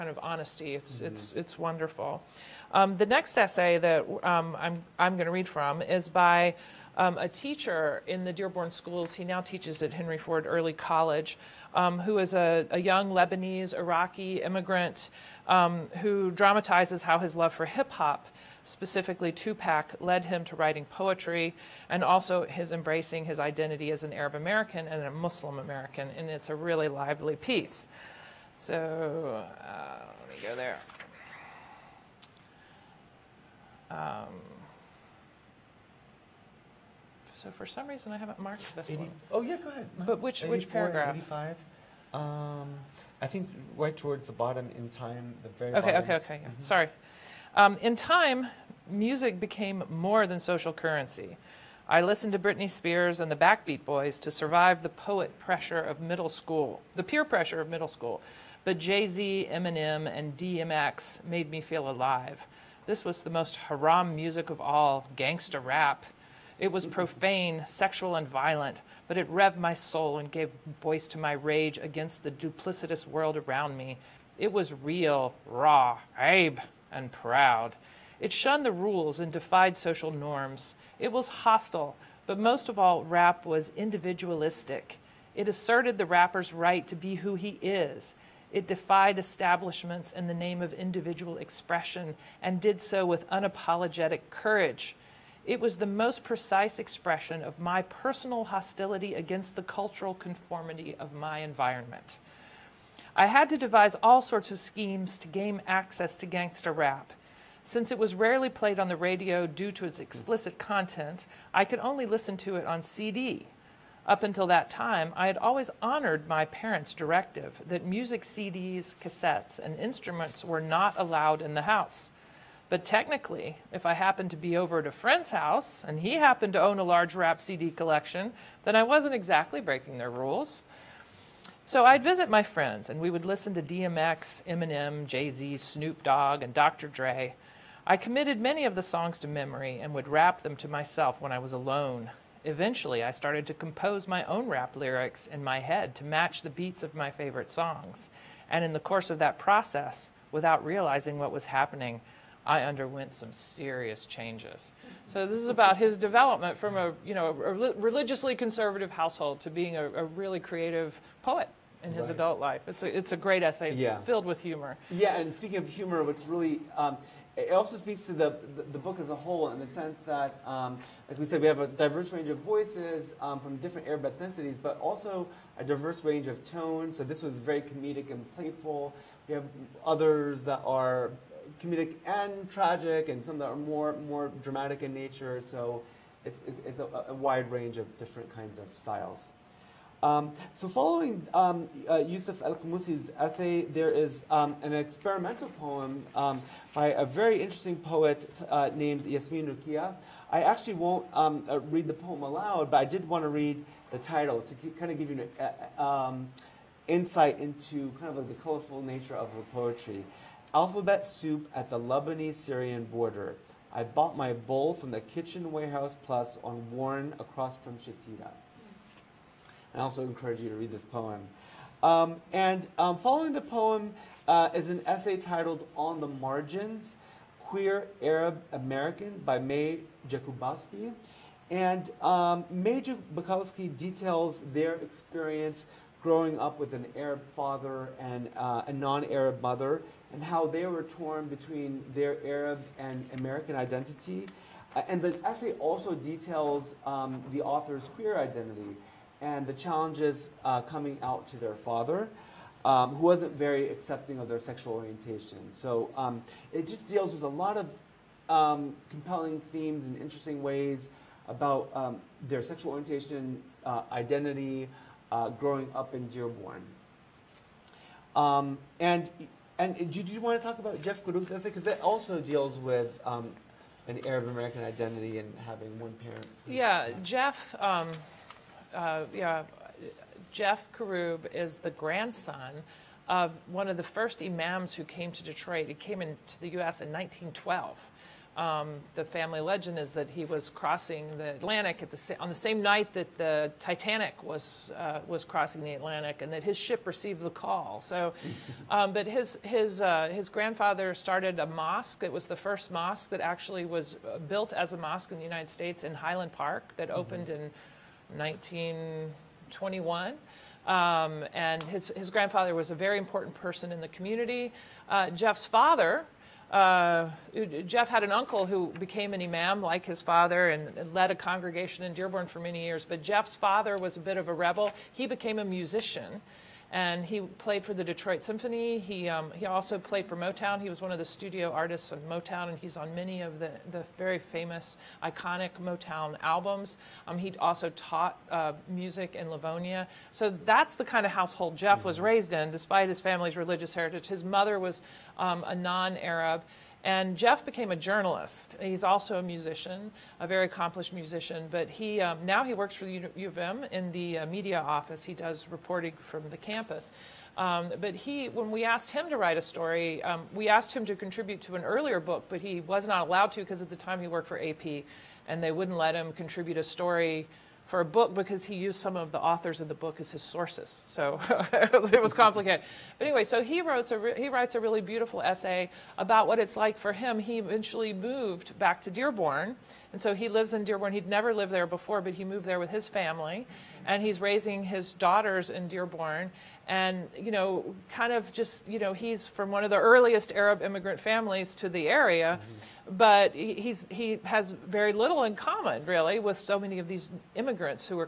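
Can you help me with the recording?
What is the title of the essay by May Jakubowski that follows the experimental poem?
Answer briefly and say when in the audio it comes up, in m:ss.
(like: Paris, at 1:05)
On the Margins Queer Arab American, at 3:45.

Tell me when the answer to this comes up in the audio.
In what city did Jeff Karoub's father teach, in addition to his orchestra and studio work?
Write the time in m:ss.
5:39.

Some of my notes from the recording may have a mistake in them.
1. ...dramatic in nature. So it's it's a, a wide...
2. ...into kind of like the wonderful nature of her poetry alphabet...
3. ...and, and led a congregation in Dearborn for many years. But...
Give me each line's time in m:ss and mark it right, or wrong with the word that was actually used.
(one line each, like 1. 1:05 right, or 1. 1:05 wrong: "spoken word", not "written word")
1. 3:04 right
2. 3:27 wrong: "colorful", not "wonderful"
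3. 5:20 right.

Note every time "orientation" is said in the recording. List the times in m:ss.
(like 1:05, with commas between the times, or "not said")
4:14, 4:22.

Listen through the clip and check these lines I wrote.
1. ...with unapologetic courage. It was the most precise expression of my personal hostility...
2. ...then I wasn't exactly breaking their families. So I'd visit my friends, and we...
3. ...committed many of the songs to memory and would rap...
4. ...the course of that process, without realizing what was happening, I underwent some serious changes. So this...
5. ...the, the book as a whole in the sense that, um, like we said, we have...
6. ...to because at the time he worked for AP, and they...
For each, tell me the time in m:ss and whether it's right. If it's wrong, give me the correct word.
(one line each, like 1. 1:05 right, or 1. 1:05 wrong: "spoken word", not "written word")
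1. 1:33 right
2. 2:08 wrong: "rules", not "families"
3. 2:17 right
4. 2:28 right
5. 2:48 right
6. 6:03 right.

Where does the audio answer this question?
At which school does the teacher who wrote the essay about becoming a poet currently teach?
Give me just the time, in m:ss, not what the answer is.
0:09.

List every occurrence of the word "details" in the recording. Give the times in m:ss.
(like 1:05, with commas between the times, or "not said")
3:53, 4:05.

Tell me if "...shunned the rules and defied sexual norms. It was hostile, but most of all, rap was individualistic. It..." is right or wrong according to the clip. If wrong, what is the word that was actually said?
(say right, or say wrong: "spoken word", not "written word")
wrong: "social", not "sexual".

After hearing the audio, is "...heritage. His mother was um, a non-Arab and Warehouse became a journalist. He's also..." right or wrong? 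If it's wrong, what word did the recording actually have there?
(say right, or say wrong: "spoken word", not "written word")
wrong: "Jeff", not "Warehouse".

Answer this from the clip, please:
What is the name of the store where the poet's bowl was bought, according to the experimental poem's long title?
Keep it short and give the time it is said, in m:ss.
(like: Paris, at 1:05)
Kitchen Warehouse Plus, at 3:35.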